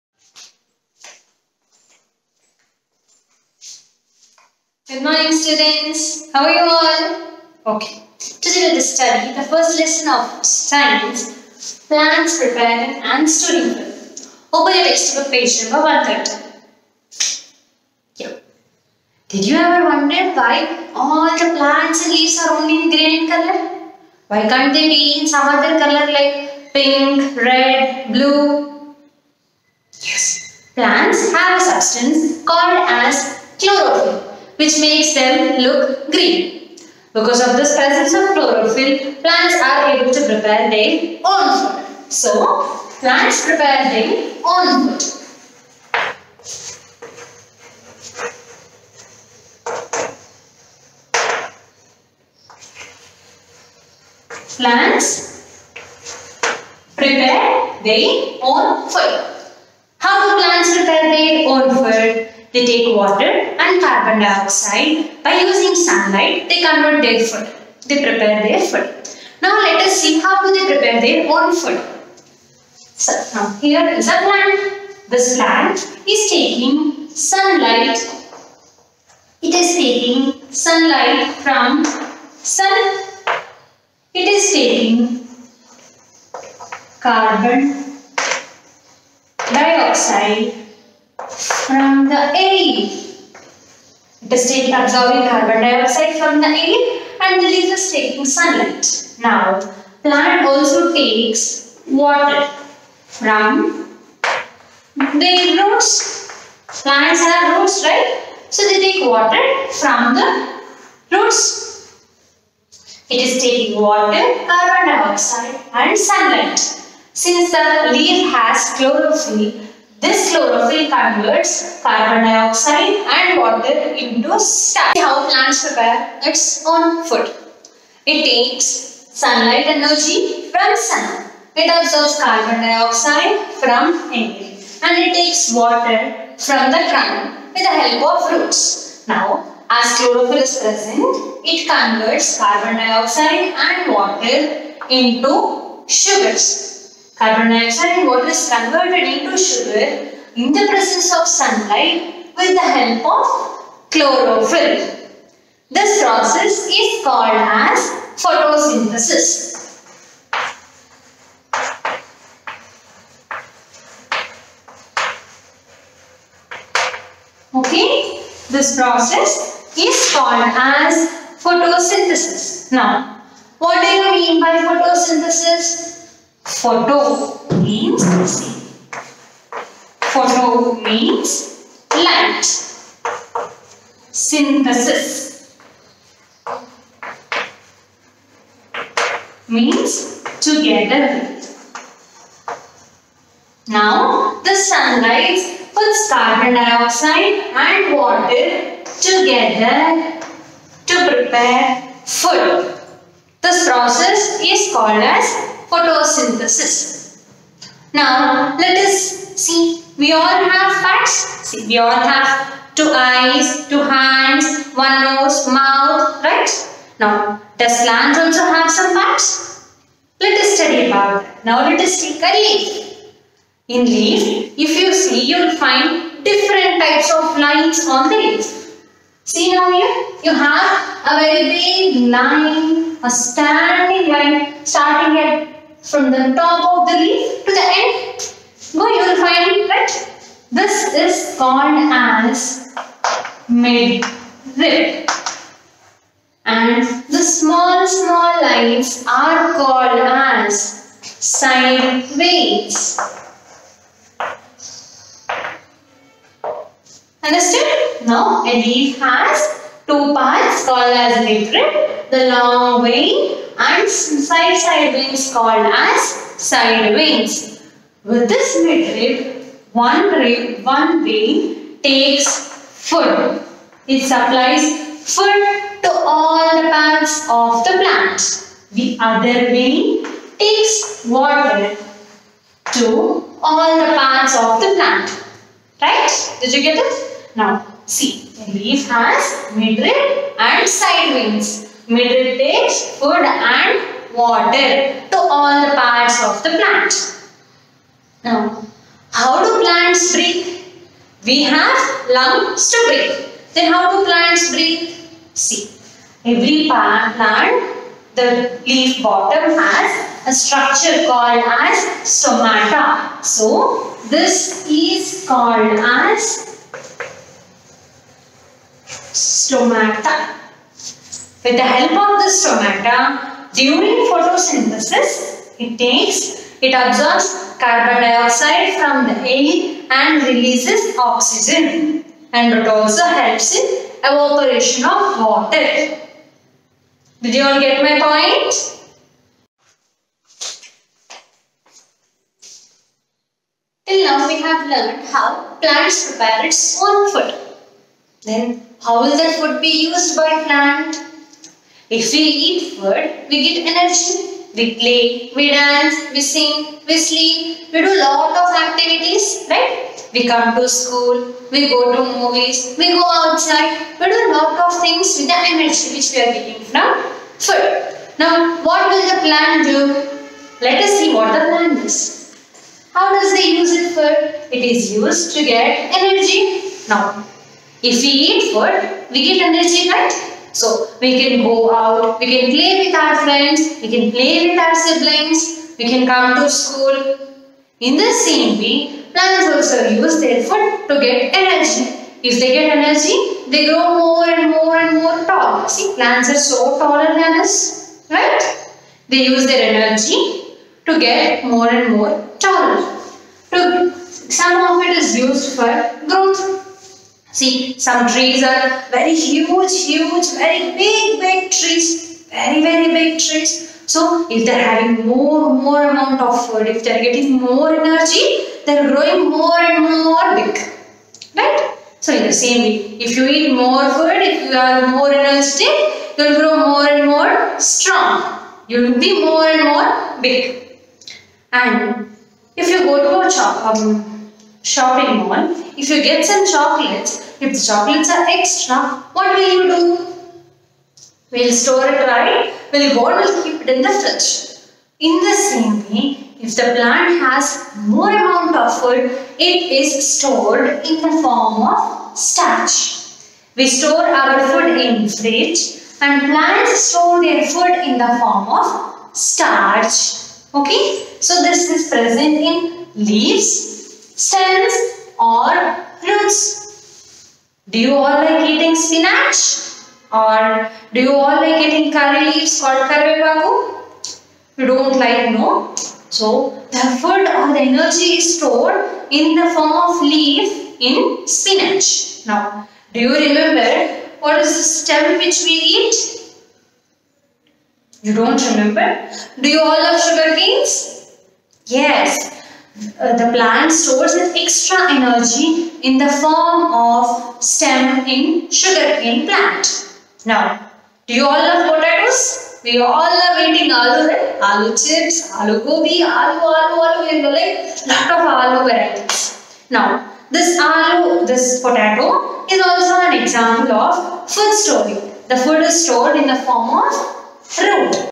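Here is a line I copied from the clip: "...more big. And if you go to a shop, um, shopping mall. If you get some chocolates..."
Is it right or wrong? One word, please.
right.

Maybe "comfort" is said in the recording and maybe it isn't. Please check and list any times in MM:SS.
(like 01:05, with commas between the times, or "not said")
not said.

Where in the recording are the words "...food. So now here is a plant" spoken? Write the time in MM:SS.
01:11.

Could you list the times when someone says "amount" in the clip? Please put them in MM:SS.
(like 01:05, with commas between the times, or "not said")
06:55, 07:28.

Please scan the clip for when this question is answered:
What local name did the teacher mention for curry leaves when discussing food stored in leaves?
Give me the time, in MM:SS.
07:52.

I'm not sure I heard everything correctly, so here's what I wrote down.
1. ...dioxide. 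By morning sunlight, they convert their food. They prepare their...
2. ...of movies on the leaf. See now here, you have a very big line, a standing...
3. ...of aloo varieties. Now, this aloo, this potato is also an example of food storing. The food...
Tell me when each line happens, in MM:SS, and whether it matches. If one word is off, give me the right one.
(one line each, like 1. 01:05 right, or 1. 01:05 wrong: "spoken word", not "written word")
1. 01:04 wrong: "using", not "morning"
2. 03:47 wrong: "lines", not "movies"
3. 08:28 right.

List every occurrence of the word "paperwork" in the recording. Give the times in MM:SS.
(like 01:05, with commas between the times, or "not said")
not said.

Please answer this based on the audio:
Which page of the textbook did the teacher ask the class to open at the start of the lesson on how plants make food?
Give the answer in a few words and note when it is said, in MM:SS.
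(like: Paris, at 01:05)
130, at 00:15.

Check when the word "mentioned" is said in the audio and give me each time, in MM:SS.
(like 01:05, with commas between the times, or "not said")
not said.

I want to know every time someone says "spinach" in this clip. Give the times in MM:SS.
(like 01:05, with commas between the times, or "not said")
07:48, 08:01.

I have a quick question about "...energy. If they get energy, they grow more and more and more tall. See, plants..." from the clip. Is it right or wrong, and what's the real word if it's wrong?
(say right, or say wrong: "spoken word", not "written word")
right.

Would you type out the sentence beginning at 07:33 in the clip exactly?
We store our food in fridge and plants store their food in the form of starch.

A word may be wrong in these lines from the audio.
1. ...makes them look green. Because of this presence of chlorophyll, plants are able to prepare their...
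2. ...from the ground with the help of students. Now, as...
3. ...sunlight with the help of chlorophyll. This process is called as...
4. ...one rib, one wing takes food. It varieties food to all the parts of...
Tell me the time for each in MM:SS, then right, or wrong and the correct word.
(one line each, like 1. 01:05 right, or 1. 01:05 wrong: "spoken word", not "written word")
1. 00:34 right
2. 02:16 wrong: "roots", not "students"
3. 02:31 right
4. 04:29 wrong: "supplies", not "varieties".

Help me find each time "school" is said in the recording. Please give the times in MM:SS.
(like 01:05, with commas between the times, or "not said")
06:00, 06:26.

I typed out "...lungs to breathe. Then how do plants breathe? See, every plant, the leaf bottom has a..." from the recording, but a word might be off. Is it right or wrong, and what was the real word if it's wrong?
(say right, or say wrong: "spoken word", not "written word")
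right.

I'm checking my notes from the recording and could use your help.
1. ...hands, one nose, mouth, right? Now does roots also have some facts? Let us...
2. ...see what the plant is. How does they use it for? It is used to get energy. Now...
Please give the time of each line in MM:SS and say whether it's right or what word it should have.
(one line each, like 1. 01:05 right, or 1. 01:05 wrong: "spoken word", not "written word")
1. 03:33 wrong: "plants", not "roots"
2. 06:10 right.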